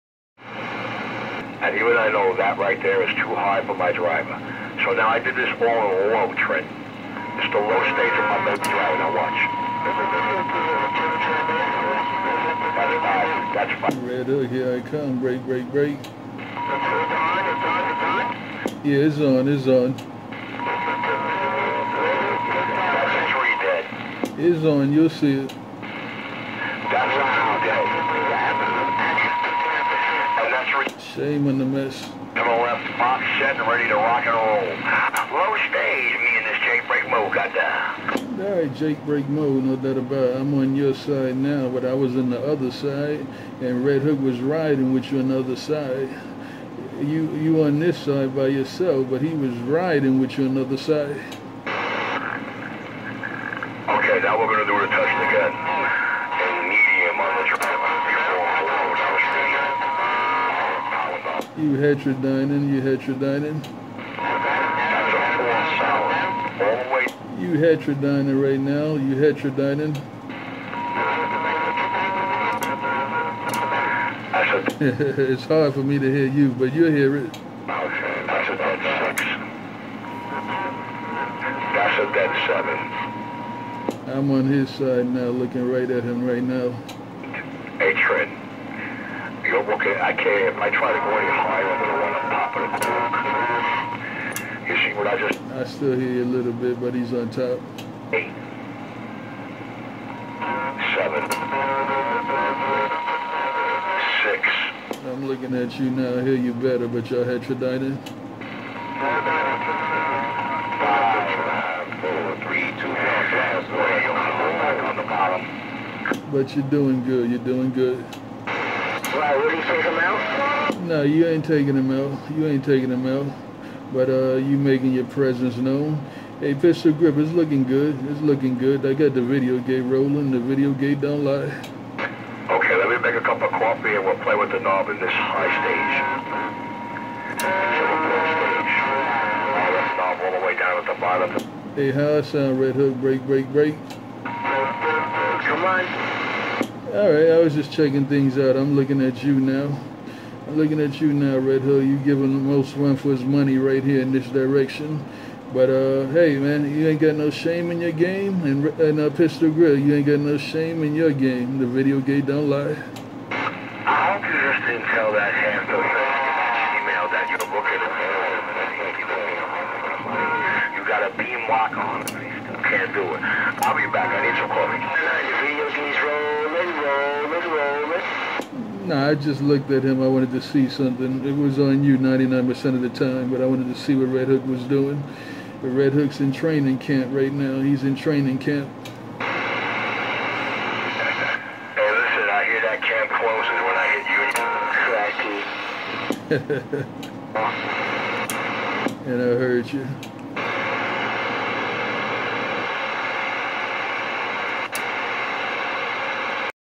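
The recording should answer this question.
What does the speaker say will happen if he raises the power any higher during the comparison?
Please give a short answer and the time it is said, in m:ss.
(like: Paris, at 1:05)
Up cork, at 1:32.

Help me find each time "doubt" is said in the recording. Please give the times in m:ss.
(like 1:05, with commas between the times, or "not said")
0:39.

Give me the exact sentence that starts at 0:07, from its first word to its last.
It's the low stage of my baby driver.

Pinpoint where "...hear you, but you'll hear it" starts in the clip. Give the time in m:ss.
1:16.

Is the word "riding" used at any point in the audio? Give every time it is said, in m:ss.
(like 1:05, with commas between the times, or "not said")
0:44, 0:49.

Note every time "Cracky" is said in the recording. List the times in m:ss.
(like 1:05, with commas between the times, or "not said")
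3:18.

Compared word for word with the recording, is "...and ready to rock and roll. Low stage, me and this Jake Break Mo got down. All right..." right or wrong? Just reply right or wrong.
right.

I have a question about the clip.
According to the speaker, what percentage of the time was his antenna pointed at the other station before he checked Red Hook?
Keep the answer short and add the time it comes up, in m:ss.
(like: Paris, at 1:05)
99%, at 3:01.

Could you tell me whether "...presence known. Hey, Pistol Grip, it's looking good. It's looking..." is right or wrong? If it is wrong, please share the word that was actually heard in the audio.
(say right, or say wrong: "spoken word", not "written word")
right.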